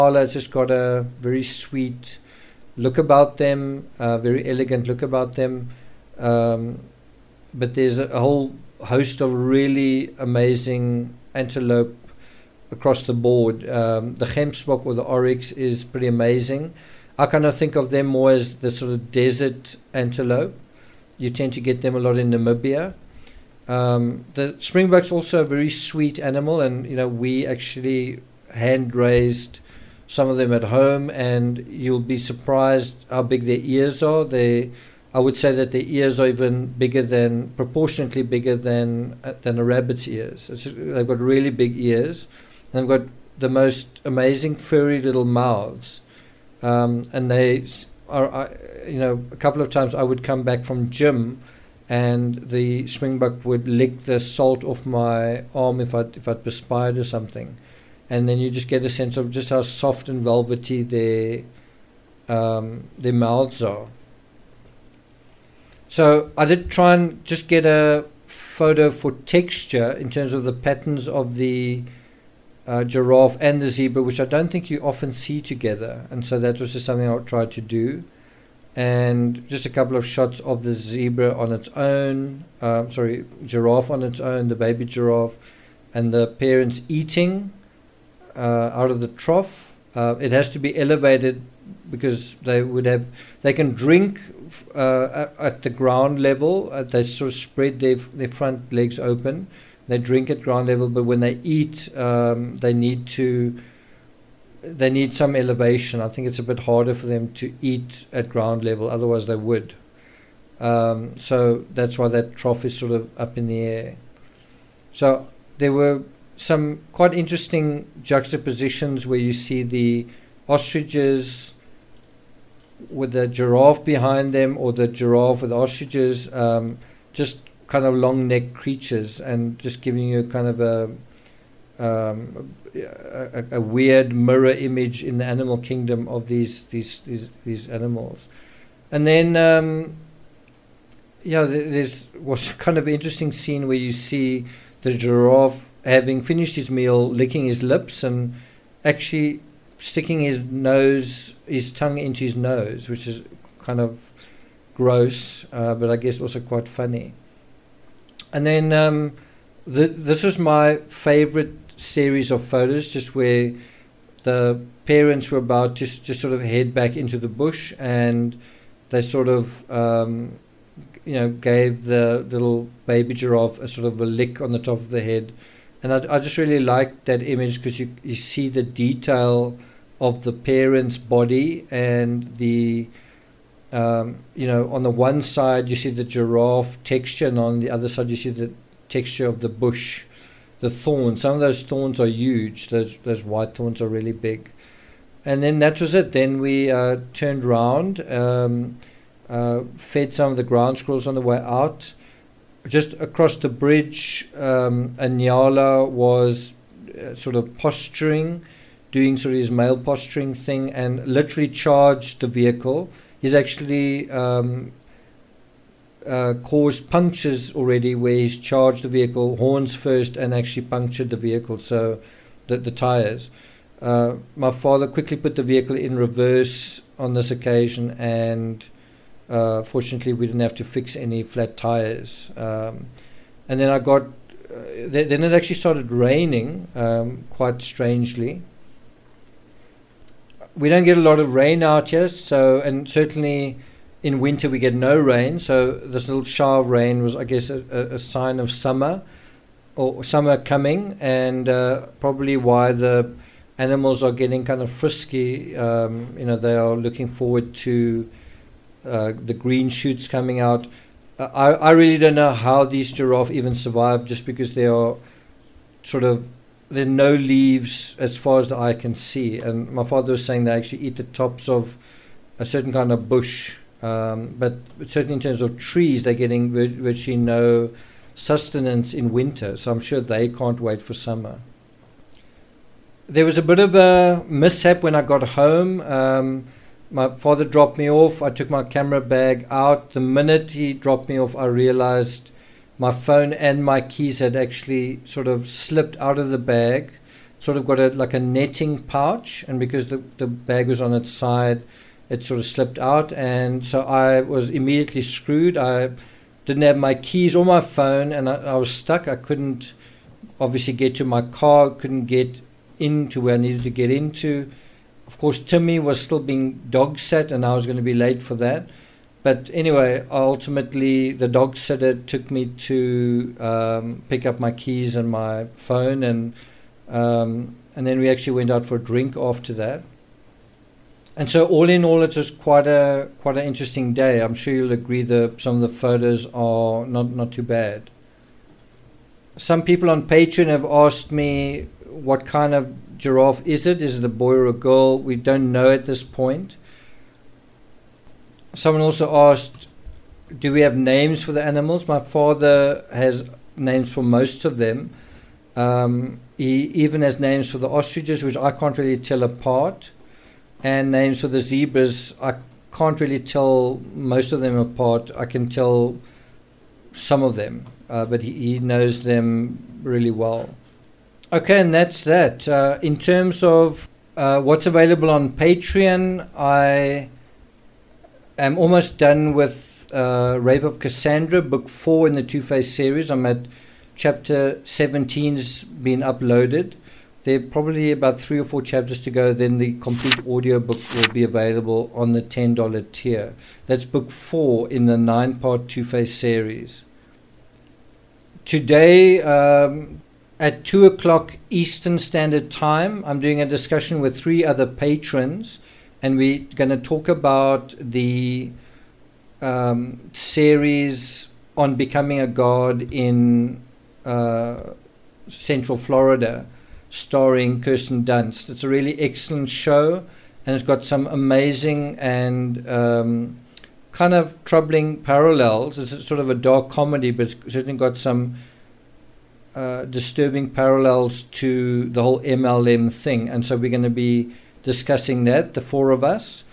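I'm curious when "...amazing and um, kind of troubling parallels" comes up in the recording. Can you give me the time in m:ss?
7:01.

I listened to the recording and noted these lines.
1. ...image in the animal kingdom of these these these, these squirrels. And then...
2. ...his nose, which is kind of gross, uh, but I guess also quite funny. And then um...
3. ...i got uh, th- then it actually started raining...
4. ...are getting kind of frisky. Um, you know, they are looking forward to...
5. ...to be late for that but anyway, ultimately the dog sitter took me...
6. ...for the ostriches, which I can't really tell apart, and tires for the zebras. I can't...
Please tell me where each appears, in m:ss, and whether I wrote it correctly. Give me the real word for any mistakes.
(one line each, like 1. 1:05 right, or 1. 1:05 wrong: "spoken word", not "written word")
1. 2:14 wrong: "animals", not "squirrels"
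2. 2:32 right
3. 3:53 right
4. 4:14 right
5. 5:17 right
6. 5:57 wrong: "names", not "tires".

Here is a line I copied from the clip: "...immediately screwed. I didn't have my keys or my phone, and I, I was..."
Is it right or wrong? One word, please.
right.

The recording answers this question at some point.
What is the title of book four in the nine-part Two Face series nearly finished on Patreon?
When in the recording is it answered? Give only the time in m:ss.
6:20.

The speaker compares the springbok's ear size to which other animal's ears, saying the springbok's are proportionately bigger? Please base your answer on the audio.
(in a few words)
rabbit.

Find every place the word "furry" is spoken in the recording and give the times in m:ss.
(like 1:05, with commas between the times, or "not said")
0:44.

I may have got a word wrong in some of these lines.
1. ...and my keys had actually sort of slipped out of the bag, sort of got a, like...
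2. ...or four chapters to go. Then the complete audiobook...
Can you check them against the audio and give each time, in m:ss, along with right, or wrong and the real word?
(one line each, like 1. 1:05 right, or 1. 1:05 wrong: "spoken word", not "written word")
1. 4:53 right
2. 6:28 right.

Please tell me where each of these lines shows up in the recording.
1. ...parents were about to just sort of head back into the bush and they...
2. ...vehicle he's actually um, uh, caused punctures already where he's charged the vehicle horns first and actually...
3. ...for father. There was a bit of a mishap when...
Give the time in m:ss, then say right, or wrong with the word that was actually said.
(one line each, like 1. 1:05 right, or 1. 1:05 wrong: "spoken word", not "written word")
1. 2:44 right
2. 3:32 right
3. 4:40 wrong: "summer", not "father".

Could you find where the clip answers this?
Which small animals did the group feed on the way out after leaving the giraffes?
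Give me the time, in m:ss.
3:20.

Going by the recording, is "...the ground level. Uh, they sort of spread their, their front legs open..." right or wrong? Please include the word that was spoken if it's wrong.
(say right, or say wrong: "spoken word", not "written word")
right.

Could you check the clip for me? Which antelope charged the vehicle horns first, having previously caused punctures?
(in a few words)
Nyala.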